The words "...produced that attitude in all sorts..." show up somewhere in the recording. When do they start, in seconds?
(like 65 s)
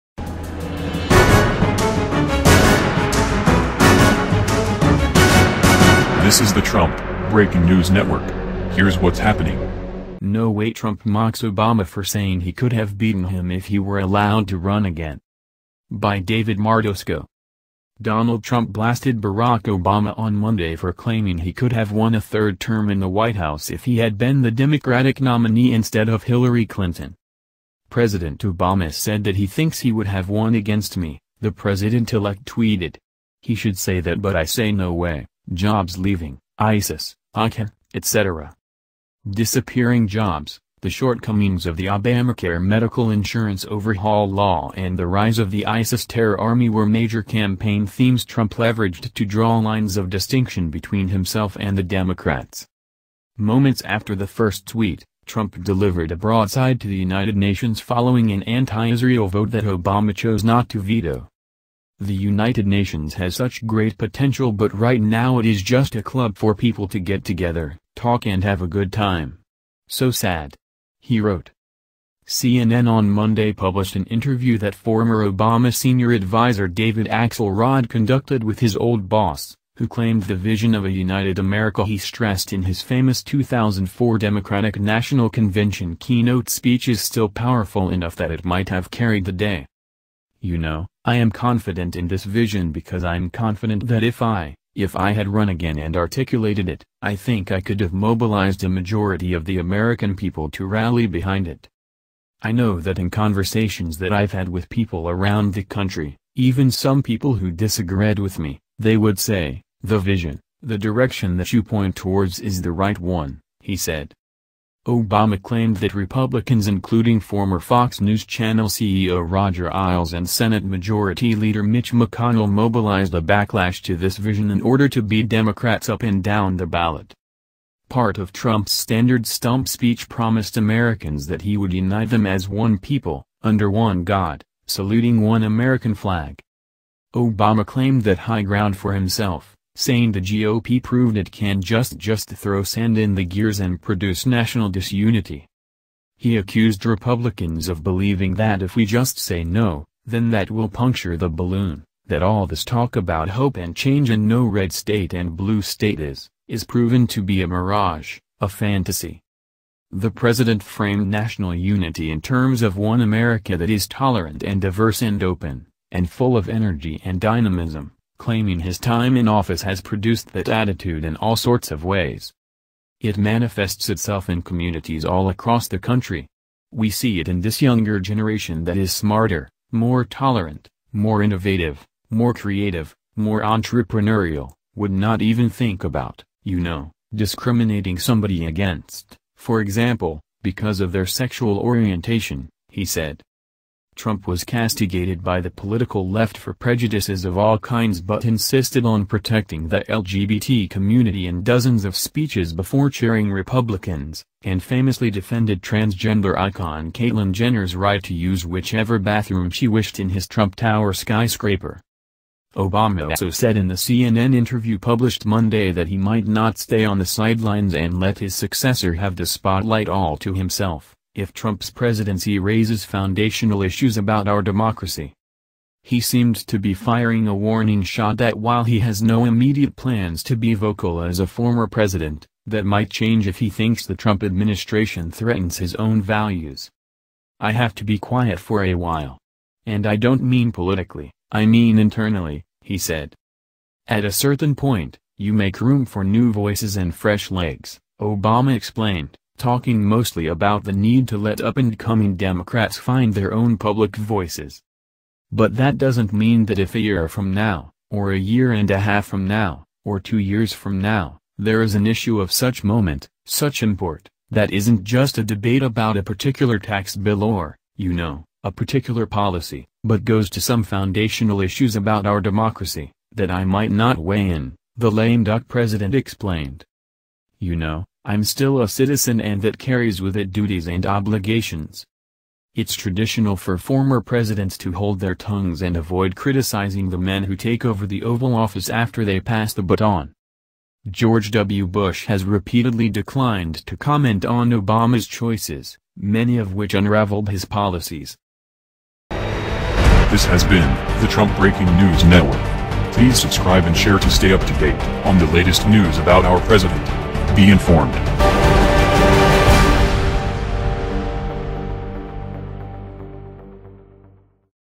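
169 s.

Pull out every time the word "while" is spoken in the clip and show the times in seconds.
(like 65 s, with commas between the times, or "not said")
228 s, 238 s.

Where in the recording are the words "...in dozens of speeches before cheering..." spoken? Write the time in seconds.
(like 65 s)
201 s.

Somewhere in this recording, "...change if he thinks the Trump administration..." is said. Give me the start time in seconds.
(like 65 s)
232 s.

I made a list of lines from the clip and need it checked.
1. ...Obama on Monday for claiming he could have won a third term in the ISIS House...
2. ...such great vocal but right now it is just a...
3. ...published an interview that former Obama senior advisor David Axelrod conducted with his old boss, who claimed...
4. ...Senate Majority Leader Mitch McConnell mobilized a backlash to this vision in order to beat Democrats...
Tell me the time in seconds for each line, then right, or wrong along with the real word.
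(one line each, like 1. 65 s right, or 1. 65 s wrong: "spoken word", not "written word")
1. 19 s wrong: "White", not "ISIS"
2. 63 s wrong: "potential", not "vocal"
3. 73 s right
4. 120 s right.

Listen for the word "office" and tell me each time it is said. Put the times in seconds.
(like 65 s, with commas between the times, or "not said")
169 s, 288 s.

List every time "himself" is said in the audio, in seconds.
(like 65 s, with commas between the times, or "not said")
51 s, 138 s, 220 s.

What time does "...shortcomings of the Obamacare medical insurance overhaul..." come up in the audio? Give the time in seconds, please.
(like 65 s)
40 s.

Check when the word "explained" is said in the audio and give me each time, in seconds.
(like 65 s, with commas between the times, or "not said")
248 s, 275 s.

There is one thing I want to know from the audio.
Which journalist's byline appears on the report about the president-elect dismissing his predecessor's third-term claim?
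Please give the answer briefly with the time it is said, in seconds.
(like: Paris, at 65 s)
David Martosko, at 16 s.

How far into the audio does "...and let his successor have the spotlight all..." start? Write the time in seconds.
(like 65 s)
217 s.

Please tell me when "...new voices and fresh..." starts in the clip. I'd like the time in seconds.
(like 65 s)
246 s.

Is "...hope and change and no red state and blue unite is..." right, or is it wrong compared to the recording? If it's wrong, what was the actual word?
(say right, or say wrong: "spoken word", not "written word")
wrong: "state", not "unite".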